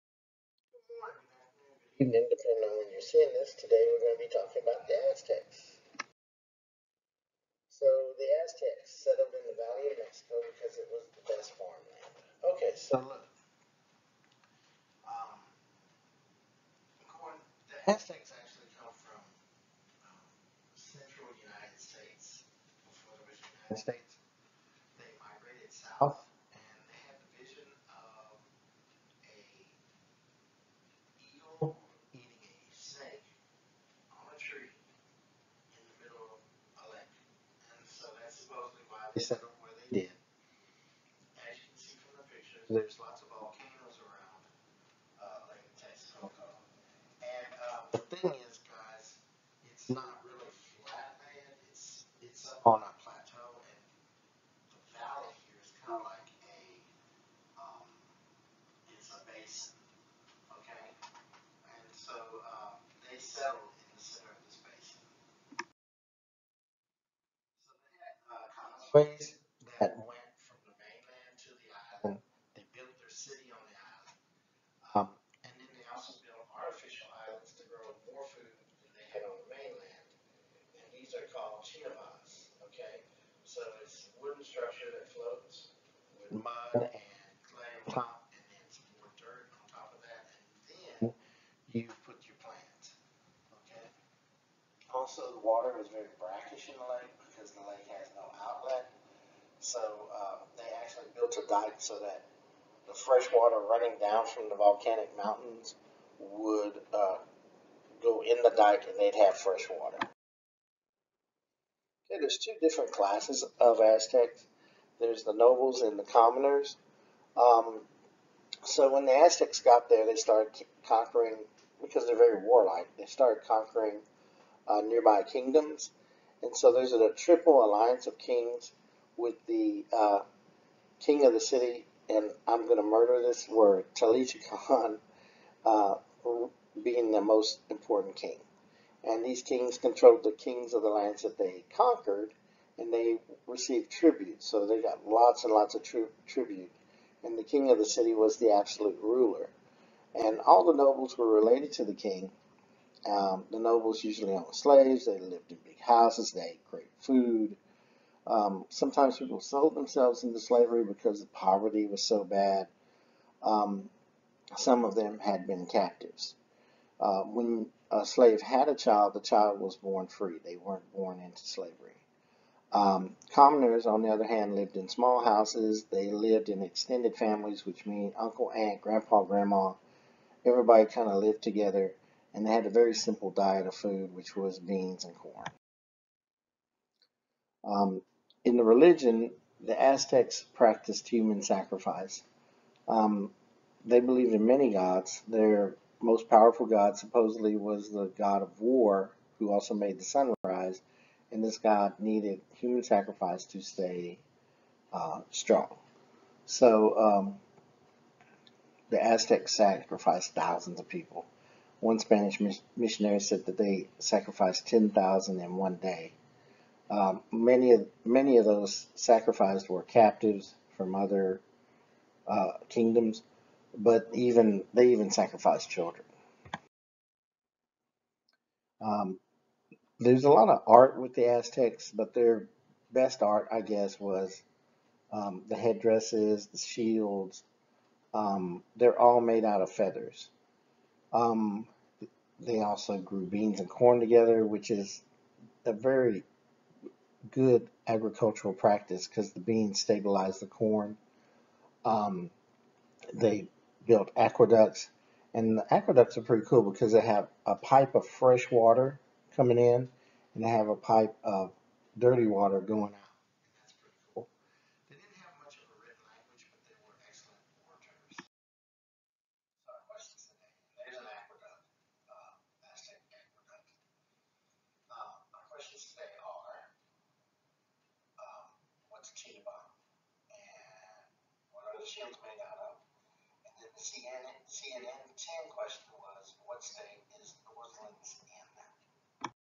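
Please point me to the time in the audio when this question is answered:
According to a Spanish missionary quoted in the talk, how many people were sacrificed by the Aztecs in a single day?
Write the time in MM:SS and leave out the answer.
03:34.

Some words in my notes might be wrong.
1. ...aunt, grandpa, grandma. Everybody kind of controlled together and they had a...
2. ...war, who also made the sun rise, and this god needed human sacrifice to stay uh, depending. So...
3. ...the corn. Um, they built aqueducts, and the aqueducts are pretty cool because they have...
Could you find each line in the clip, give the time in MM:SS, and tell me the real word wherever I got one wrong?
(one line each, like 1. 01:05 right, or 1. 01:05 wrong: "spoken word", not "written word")
1. 02:58 wrong: "lived", not "controlled"
2. 03:18 wrong: "strong", not "depending"
3. 04:10 right.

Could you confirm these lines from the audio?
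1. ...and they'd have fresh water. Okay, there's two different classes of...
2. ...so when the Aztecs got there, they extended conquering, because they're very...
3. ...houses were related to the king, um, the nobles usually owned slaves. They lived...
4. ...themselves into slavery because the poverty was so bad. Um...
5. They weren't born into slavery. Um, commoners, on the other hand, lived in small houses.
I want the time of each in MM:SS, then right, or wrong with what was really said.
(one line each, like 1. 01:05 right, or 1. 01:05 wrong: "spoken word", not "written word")
1. 01:48 right
2. 01:58 wrong: "started", not "extended"
3. 02:30 wrong: "nobles", not "houses"
4. 02:39 right
5. 02:50 right.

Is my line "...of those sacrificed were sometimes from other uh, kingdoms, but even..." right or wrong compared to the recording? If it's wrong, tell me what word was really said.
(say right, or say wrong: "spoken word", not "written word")
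wrong: "captives", not "sometimes".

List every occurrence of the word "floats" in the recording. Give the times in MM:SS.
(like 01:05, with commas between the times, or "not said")
01:25.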